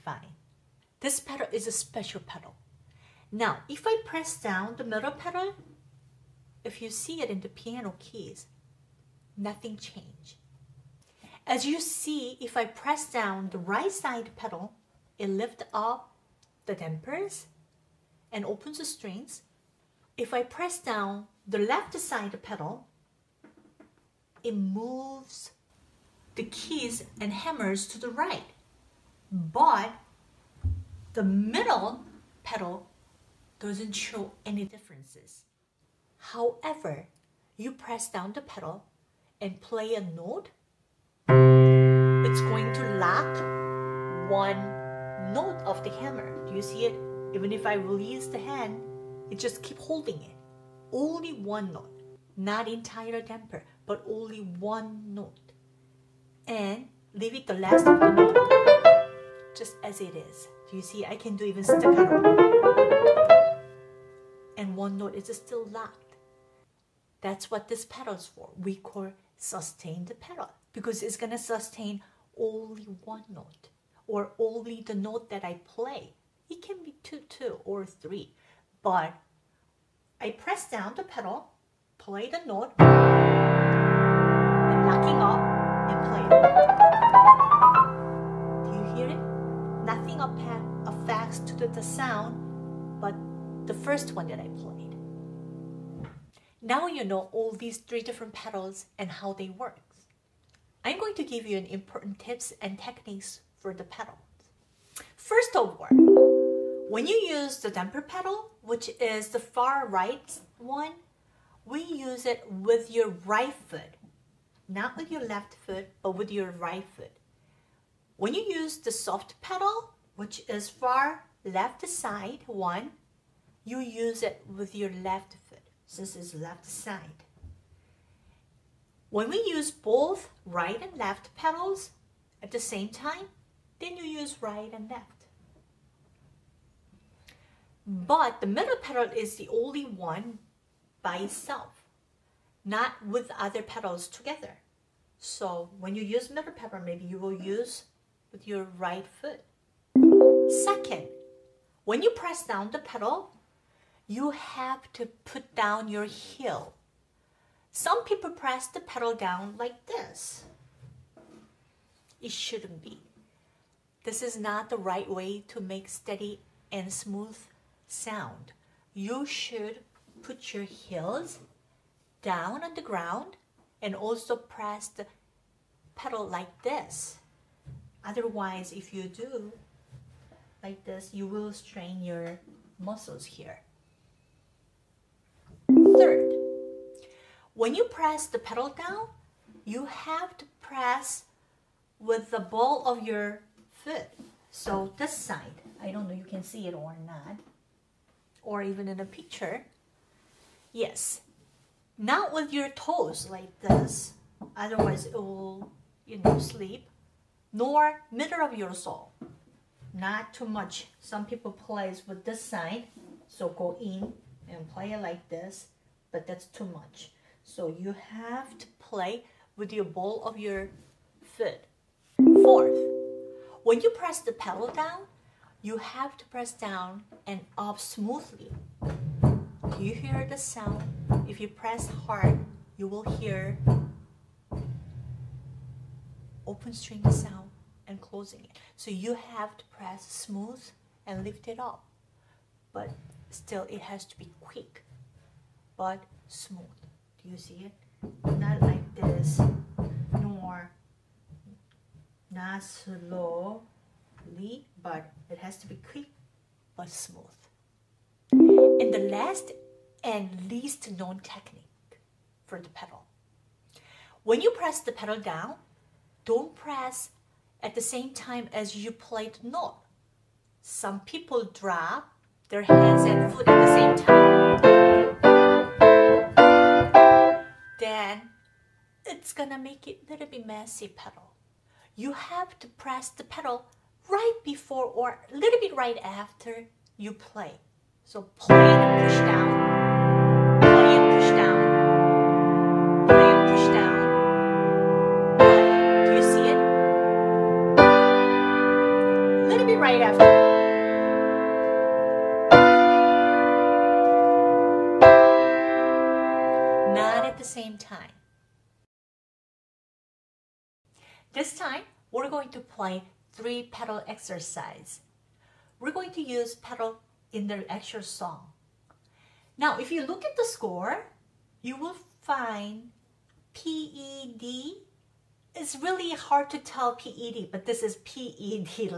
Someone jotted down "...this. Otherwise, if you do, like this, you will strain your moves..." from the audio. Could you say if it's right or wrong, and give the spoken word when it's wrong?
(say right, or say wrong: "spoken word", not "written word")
wrong: "muscles", not "moves".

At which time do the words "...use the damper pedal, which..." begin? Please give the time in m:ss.
1:47.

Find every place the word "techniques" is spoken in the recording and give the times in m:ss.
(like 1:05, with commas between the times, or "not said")
1:42, 4:21.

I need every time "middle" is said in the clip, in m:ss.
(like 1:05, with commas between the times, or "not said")
0:04, 0:31, 2:18, 2:26, 3:28.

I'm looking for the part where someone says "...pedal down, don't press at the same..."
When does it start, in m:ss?
4:24.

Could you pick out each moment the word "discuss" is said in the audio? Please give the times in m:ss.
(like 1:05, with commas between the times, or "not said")
not said.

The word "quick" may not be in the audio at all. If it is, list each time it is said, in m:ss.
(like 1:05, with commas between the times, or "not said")
4:04, 4:15.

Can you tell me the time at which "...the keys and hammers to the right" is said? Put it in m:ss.
0:26.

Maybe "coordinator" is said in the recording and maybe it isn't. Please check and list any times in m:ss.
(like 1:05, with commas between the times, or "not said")
not said.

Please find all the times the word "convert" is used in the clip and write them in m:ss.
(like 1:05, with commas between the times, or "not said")
not said.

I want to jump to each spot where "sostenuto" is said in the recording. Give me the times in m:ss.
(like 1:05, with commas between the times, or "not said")
1:09.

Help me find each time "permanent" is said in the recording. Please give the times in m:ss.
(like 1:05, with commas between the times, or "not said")
not said.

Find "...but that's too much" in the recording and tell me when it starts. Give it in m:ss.
3:36.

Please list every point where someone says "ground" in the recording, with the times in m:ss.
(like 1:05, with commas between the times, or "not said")
2:52.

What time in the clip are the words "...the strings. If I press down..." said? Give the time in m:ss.
0:18.